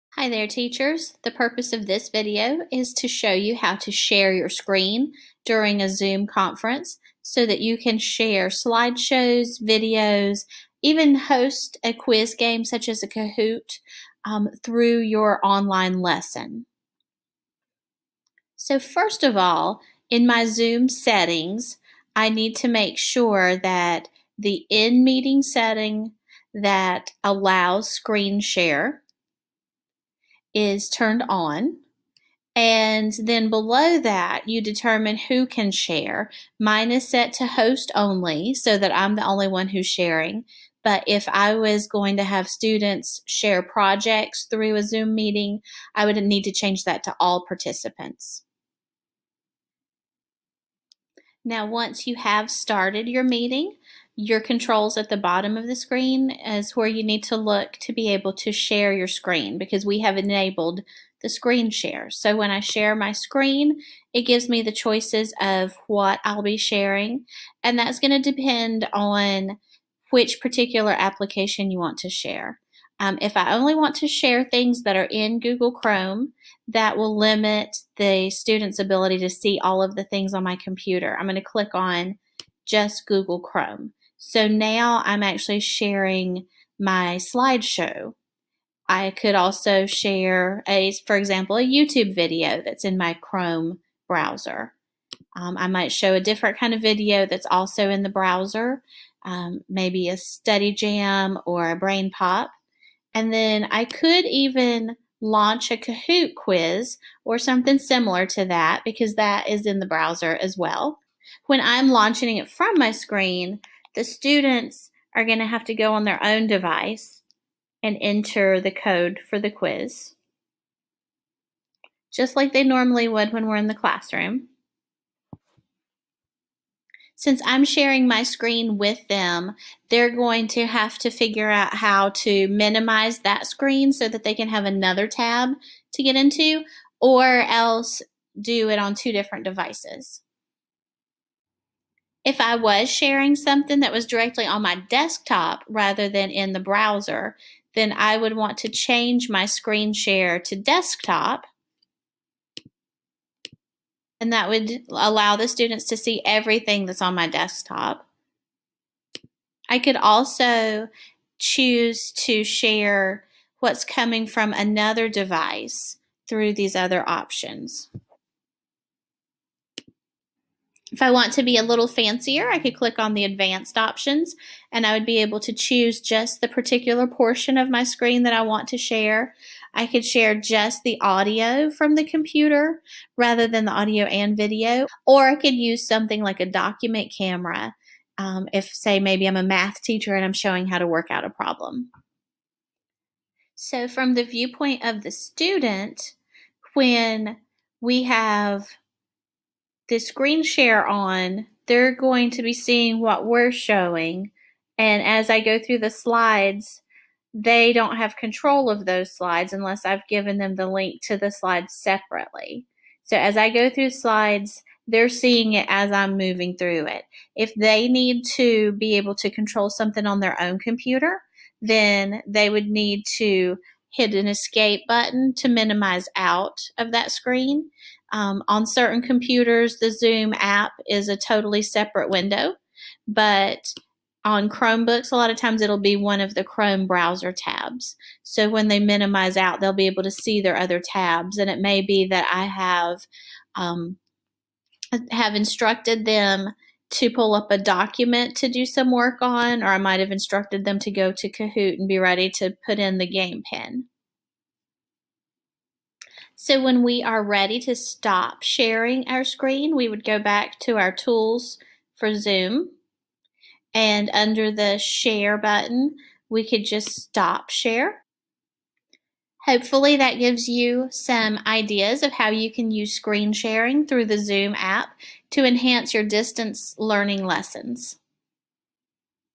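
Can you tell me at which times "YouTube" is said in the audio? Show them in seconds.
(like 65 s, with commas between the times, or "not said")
91 s.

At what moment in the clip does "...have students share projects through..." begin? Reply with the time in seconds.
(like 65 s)
42 s.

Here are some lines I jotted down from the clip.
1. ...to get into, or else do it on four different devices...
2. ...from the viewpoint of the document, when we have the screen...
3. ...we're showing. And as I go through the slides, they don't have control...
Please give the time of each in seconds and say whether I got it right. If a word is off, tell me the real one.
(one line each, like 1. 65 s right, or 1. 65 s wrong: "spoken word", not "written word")
1. 135 s wrong: "two", not "four"
2. 193 s wrong: "student", not "document"
3. 203 s right.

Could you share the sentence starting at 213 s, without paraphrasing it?
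So as I go through slides, they're seeing it as I'm moving through it.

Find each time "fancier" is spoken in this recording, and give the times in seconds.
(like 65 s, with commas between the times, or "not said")
171 s.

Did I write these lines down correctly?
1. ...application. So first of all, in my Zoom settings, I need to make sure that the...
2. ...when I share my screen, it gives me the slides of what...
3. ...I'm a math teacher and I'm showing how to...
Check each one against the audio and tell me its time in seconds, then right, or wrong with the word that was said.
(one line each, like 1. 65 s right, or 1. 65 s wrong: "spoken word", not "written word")
1. 16 s wrong: "lesson", not "application"
2. 62 s wrong: "choices", not "slides"
3. 189 s right.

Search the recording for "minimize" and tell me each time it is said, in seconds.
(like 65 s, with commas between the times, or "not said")
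132 s, 225 s, 238 s.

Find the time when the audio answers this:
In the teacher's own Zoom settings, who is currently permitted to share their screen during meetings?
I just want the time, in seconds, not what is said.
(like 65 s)
37 s.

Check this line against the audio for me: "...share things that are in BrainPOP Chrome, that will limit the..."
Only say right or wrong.
wrong.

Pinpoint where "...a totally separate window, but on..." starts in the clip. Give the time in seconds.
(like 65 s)
231 s.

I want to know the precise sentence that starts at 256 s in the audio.
So when we are ready to stop sharing our screen, we would go back to our tools for Zoom.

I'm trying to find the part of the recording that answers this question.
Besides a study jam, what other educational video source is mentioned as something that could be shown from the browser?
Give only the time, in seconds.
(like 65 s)
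101 s.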